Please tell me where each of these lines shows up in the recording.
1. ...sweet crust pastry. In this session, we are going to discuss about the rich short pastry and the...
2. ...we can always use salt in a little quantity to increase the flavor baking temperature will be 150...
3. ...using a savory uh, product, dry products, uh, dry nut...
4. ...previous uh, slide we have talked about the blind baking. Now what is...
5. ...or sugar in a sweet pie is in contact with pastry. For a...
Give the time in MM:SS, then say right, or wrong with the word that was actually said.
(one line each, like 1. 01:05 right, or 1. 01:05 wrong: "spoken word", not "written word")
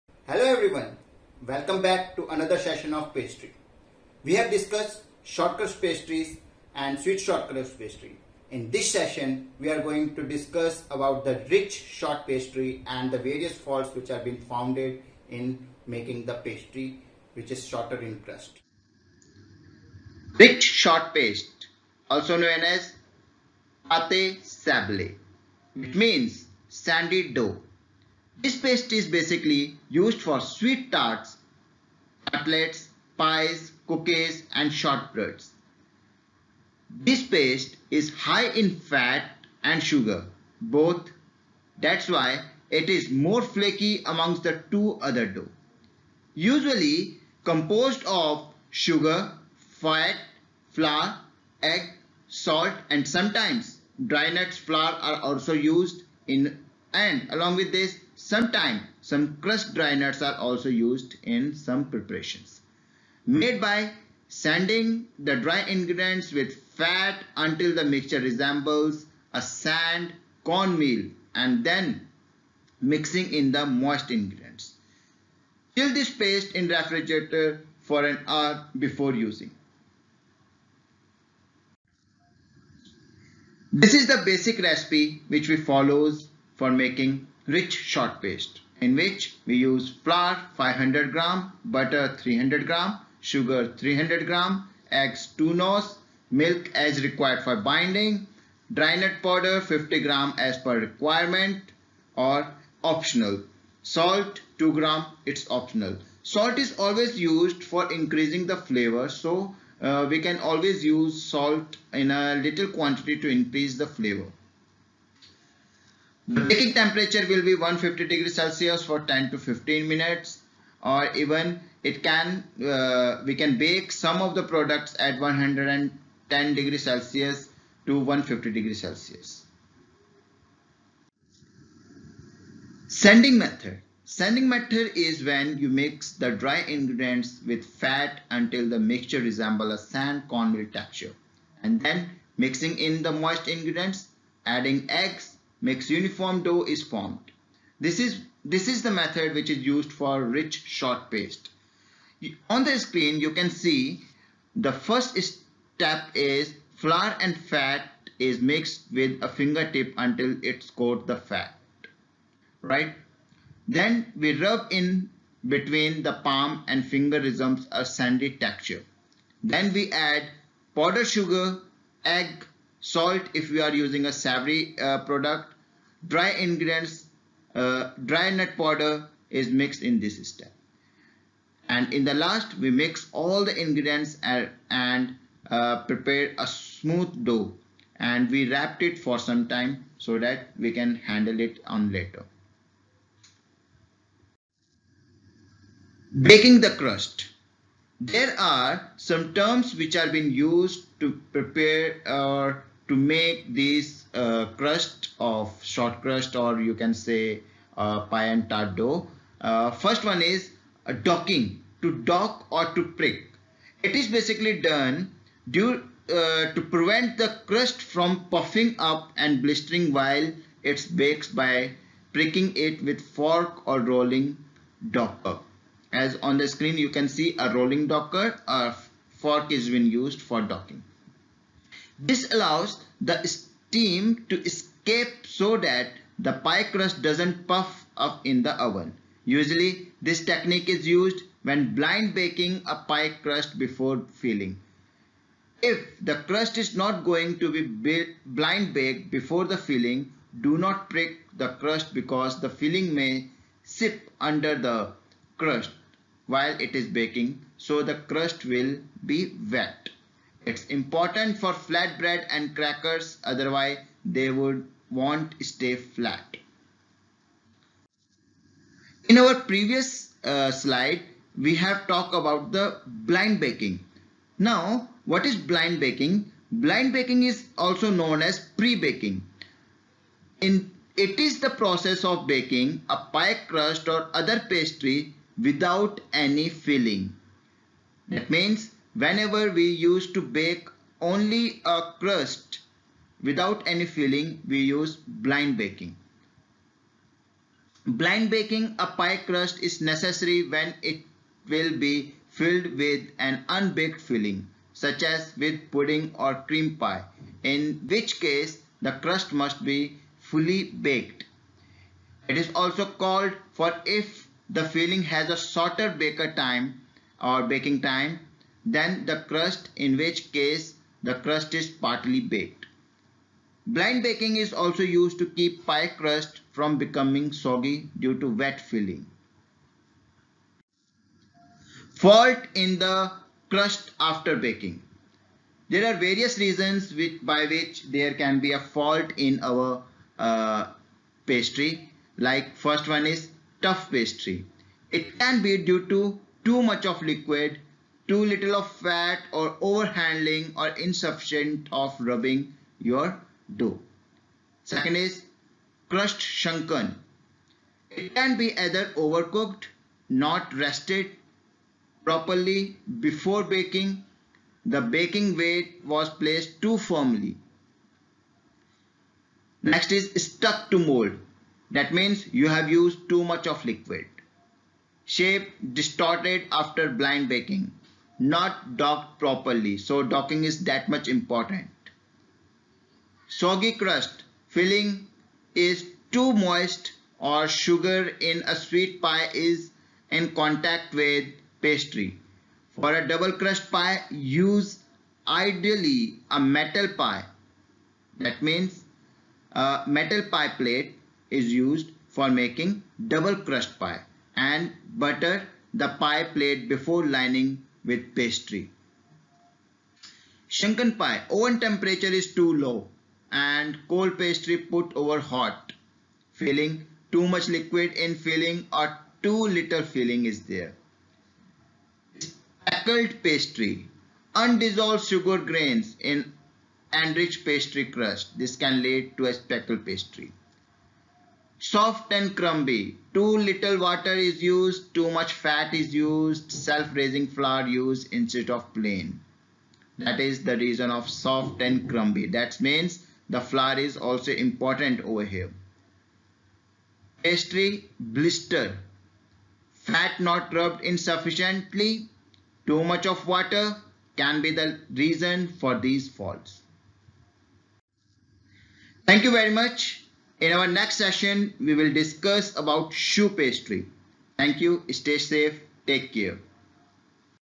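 1. 00:06 wrong: "shortcrust", not "crust"
2. 01:50 right
3. 02:53 wrong: "ingredients", not "products"
4. 04:29 right
5. 06:27 right.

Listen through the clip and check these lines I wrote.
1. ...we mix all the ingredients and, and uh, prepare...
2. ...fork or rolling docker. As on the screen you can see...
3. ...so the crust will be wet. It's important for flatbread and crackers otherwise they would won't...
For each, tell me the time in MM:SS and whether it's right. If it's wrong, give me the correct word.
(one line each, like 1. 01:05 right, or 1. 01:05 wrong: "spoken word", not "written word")
1. 03:02 right
2. 03:43 right
3. 04:17 right.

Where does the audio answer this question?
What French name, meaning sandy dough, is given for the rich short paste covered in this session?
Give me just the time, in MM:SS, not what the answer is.
00:24.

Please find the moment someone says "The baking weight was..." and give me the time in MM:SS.
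06:04.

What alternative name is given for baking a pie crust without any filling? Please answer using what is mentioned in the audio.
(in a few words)
Pre-baking.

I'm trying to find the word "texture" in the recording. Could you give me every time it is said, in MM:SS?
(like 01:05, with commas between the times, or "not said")
02:20, 02:48.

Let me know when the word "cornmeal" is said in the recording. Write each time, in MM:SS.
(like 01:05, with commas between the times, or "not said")
01:10, 02:20.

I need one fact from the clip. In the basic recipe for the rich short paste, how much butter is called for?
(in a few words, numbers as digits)
300 grams.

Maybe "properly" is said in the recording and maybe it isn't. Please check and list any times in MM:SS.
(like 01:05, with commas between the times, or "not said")
06:02, 06:19.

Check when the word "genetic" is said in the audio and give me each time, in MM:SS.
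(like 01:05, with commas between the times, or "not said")
not said.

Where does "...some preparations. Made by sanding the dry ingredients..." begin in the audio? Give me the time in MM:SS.
01:01.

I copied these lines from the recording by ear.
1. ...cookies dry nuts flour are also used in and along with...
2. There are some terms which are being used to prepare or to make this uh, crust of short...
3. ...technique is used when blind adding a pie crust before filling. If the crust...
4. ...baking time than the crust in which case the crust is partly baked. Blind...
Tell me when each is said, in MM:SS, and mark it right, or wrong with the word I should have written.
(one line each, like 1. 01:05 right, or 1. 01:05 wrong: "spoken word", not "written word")
1. 00:53 wrong: "sometimes", not "cookies"
2. 03:18 right
3. 04:00 wrong: "baking", not "adding"
4. 05:17 right.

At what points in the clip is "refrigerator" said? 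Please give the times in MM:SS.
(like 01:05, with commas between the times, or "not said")
01:16.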